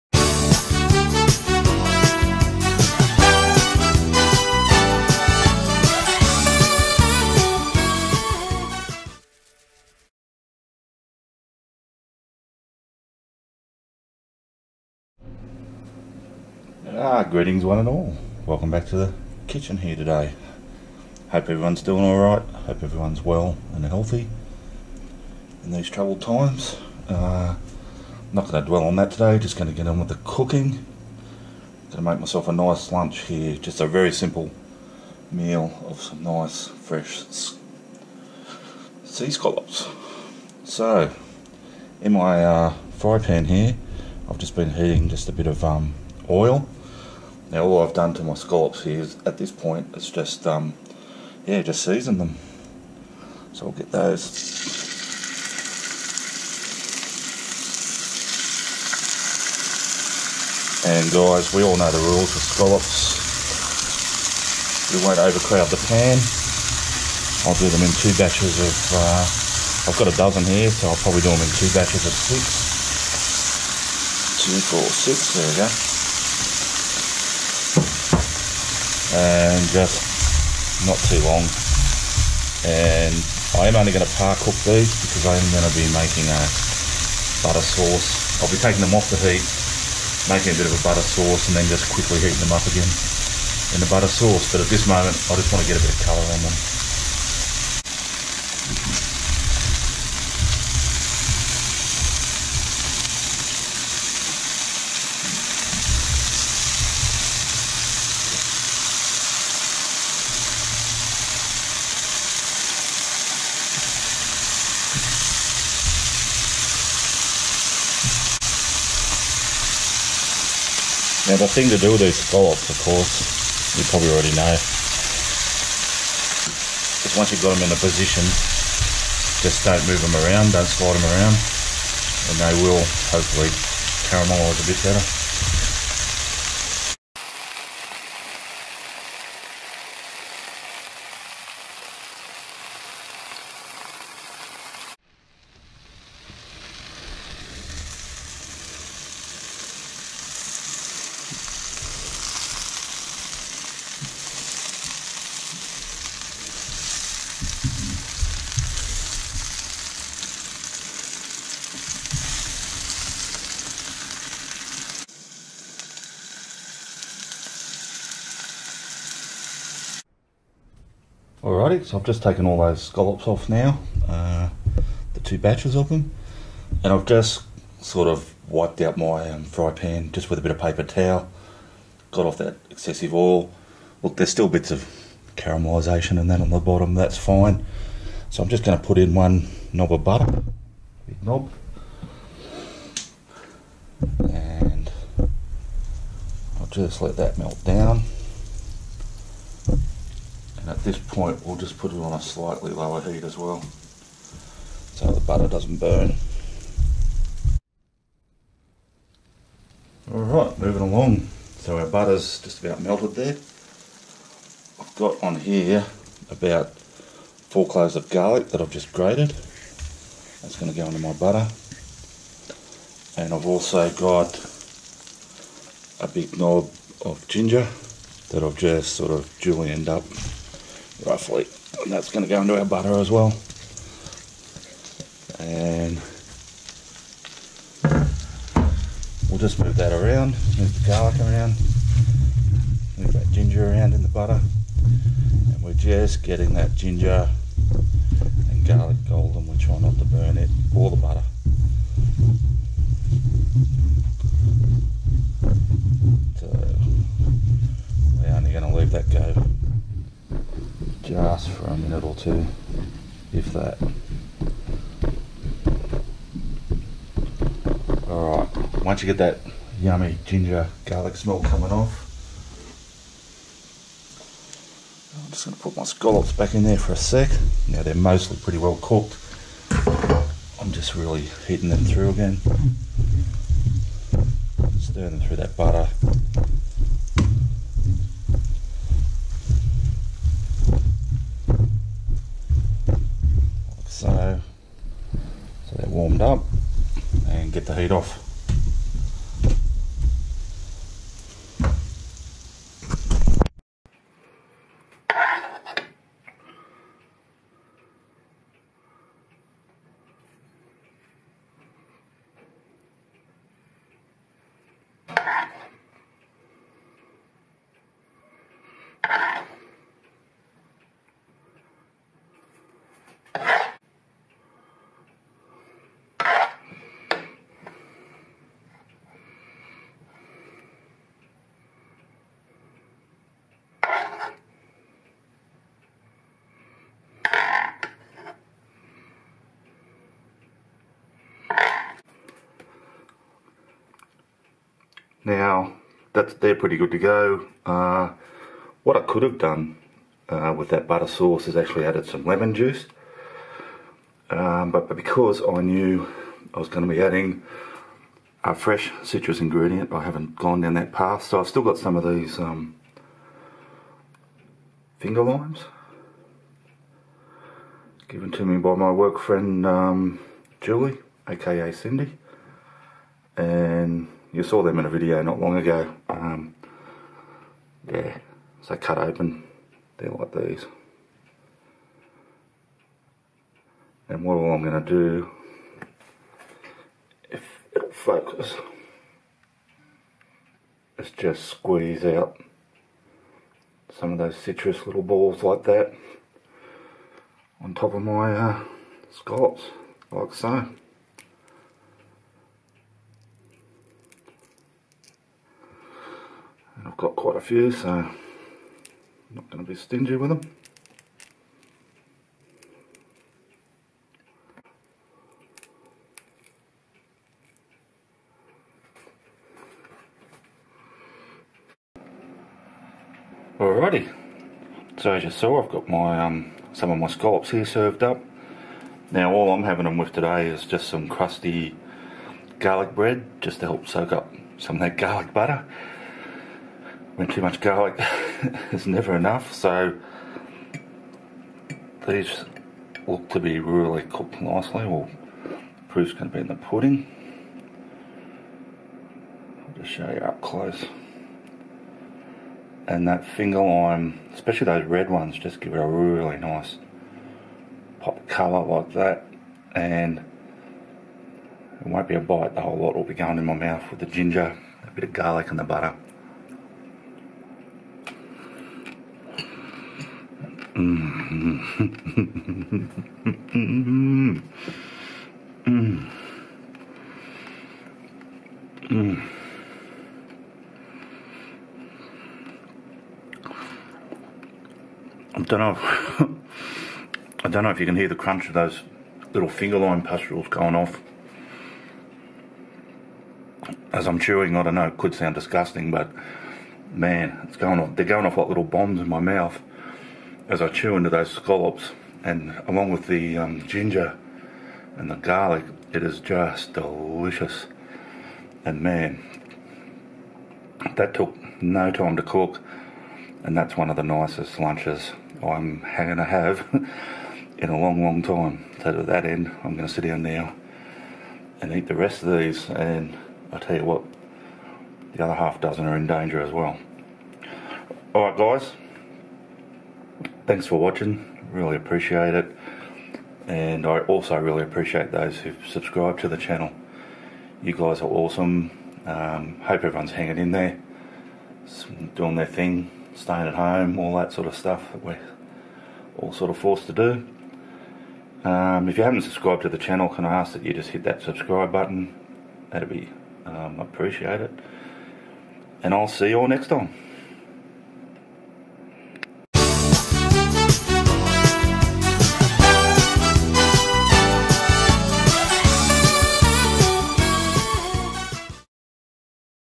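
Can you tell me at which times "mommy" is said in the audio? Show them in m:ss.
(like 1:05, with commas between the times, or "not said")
not said.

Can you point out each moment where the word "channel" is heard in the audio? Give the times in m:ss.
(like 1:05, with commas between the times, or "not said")
8:56, 9:09.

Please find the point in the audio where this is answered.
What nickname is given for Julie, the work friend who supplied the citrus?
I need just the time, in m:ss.
6:11.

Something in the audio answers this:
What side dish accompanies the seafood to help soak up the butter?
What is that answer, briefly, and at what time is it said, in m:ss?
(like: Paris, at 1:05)
Crusty garlic bread, at 7:11.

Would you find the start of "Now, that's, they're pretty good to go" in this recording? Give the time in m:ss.
5:45.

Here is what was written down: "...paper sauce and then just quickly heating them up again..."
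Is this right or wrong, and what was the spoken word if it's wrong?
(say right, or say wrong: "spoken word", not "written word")
wrong: "butter", not "paper".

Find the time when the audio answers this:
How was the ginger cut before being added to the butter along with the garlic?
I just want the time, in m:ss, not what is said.
3:49.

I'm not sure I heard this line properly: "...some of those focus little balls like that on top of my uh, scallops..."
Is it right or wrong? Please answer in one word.
wrong.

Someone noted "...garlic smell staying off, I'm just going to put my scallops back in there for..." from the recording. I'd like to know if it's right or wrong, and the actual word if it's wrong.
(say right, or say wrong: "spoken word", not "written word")
wrong: "coming", not "staying".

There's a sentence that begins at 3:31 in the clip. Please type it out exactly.
So our butter's just about melted there.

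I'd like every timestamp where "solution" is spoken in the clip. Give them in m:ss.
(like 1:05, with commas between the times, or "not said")
not said.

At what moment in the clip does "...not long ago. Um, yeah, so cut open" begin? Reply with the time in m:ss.
6:15.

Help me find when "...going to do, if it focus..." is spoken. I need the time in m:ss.
6:24.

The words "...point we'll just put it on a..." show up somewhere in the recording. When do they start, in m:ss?
3:20.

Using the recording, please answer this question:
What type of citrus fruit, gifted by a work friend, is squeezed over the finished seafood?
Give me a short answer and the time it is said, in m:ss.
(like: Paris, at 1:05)
Finger limes, at 6:04.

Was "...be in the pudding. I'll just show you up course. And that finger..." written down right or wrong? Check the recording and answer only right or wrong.
wrong.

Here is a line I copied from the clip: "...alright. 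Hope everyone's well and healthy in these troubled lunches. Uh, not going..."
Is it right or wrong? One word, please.
wrong.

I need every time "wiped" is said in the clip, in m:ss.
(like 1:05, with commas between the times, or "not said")
2:58.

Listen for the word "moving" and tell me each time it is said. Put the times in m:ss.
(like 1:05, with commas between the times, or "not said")
3:30.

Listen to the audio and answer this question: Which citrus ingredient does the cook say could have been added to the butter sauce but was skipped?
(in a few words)
Lemon juice.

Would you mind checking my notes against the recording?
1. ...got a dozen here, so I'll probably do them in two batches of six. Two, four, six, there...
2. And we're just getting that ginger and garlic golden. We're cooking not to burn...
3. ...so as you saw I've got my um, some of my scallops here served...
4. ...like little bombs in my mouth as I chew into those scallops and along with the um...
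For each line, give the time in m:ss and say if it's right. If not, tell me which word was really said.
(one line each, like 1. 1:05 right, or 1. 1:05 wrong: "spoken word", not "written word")
1. 1:09 right
2. 4:05 wrong: "trying", not "cooking"
3. 7:04 right
4. 8:18 right.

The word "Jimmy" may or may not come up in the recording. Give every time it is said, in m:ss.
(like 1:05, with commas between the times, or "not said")
not said.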